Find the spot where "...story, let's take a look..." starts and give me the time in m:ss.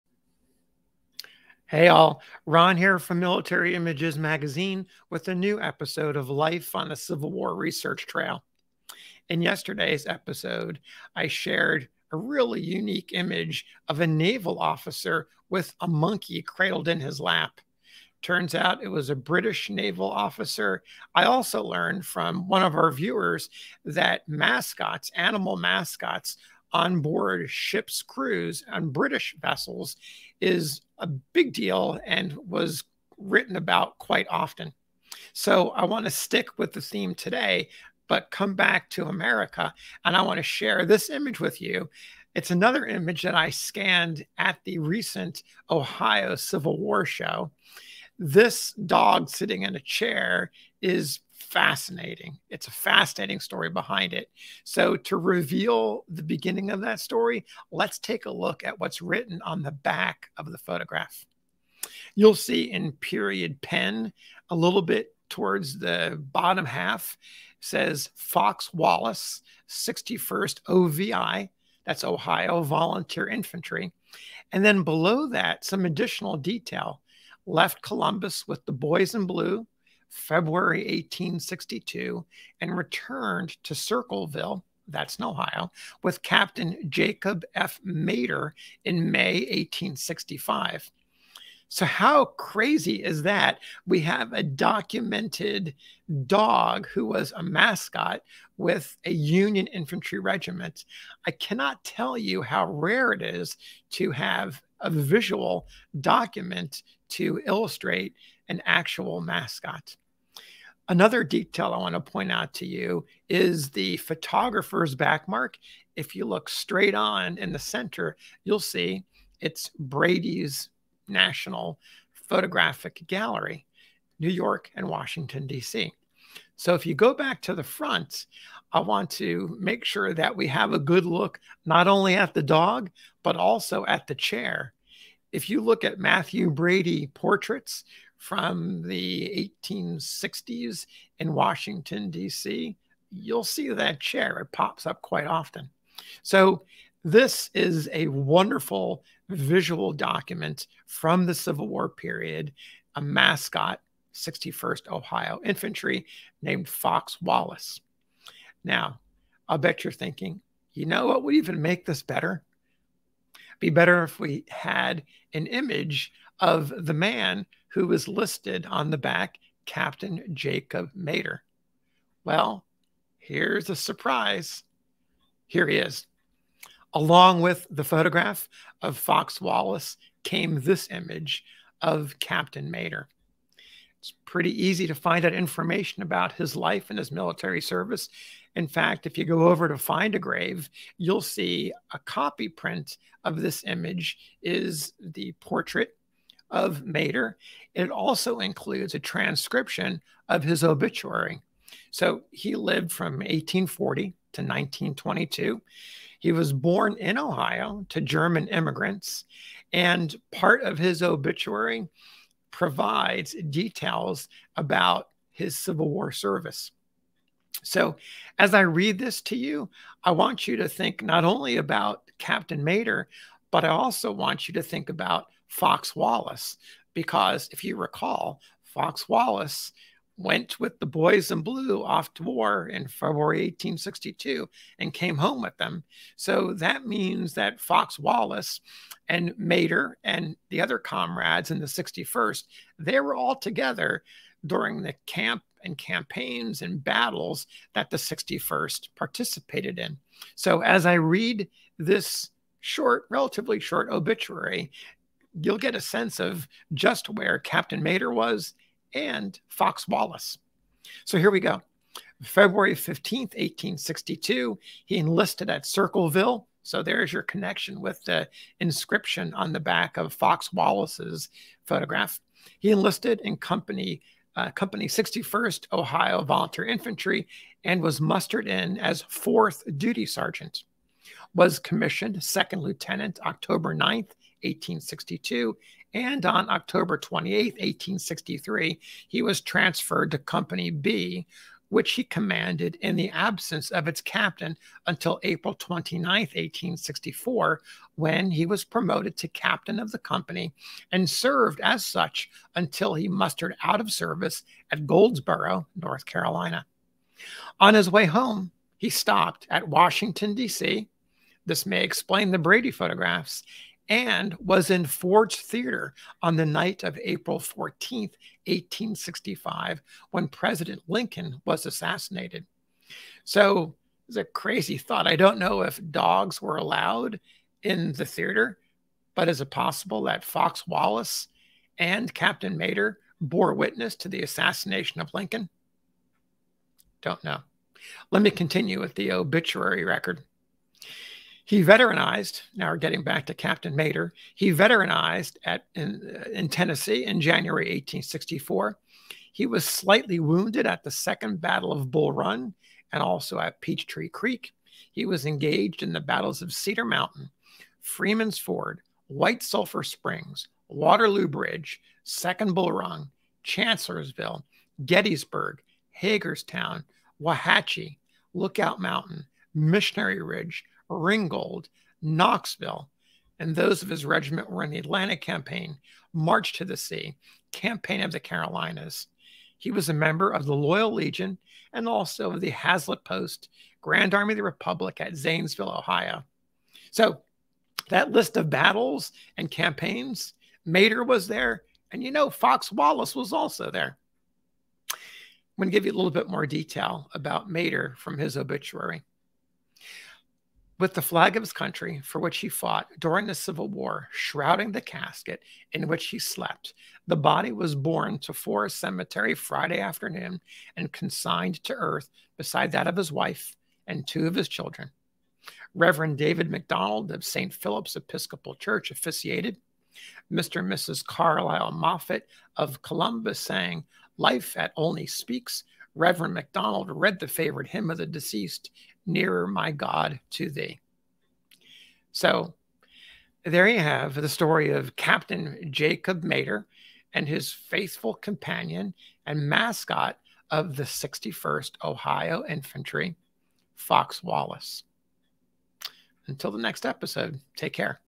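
0:57.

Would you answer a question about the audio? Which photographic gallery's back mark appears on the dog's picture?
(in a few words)
Brady's National Photographic Gallery.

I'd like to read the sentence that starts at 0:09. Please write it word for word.
In yesterday's episode, I shared a really unique image of a naval officer with a monkey cradled in his lap.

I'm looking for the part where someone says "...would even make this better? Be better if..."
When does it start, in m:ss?
2:41.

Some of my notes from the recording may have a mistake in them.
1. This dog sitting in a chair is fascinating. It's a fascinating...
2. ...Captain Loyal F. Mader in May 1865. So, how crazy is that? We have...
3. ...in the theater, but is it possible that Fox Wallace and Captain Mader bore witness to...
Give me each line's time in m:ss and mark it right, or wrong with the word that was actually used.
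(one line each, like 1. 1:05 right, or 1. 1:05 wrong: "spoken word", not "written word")
1. 0:48 right
2. 1:26 wrong: "Jacob", not "Loyal"
3. 5:27 right.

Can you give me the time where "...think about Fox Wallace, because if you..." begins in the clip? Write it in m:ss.
3:44.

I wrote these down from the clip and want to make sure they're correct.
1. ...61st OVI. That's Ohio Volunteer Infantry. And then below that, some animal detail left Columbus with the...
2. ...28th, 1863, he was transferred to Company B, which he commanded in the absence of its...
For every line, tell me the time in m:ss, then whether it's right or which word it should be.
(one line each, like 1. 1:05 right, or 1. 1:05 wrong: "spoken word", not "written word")
1. 1:09 wrong: "additional", not "animal"
2. 4:46 right.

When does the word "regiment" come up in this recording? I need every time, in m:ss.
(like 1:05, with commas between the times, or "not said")
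1:40, 6:14.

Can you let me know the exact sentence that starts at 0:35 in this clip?
So I want to stick with the theme today, but come back to America.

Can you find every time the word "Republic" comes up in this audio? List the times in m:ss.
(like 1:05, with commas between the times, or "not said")
6:24.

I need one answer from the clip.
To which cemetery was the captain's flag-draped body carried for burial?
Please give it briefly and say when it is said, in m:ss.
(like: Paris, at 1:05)
Forest Cemetery, at 6:48.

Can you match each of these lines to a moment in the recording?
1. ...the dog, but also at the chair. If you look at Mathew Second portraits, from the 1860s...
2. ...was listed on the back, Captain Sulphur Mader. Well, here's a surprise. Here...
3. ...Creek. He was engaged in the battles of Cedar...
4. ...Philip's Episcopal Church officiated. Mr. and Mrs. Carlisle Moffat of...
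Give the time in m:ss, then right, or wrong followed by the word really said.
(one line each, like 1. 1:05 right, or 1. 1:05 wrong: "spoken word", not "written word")
1. 2:12 wrong: "Brady", not "Second"
2. 2:47 wrong: "Jacob", not "Sulphur"
3. 5:54 right
4. 6:57 right.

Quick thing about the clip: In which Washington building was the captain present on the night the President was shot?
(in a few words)
Ford's Theater.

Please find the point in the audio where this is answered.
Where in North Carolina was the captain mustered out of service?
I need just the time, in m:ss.
5:04.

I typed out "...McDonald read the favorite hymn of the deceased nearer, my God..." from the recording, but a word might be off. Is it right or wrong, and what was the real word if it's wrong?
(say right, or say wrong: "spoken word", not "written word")
right.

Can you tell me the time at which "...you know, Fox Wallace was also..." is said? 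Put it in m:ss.
6:32.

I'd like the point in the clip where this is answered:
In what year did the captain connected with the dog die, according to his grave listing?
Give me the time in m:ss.
3:24.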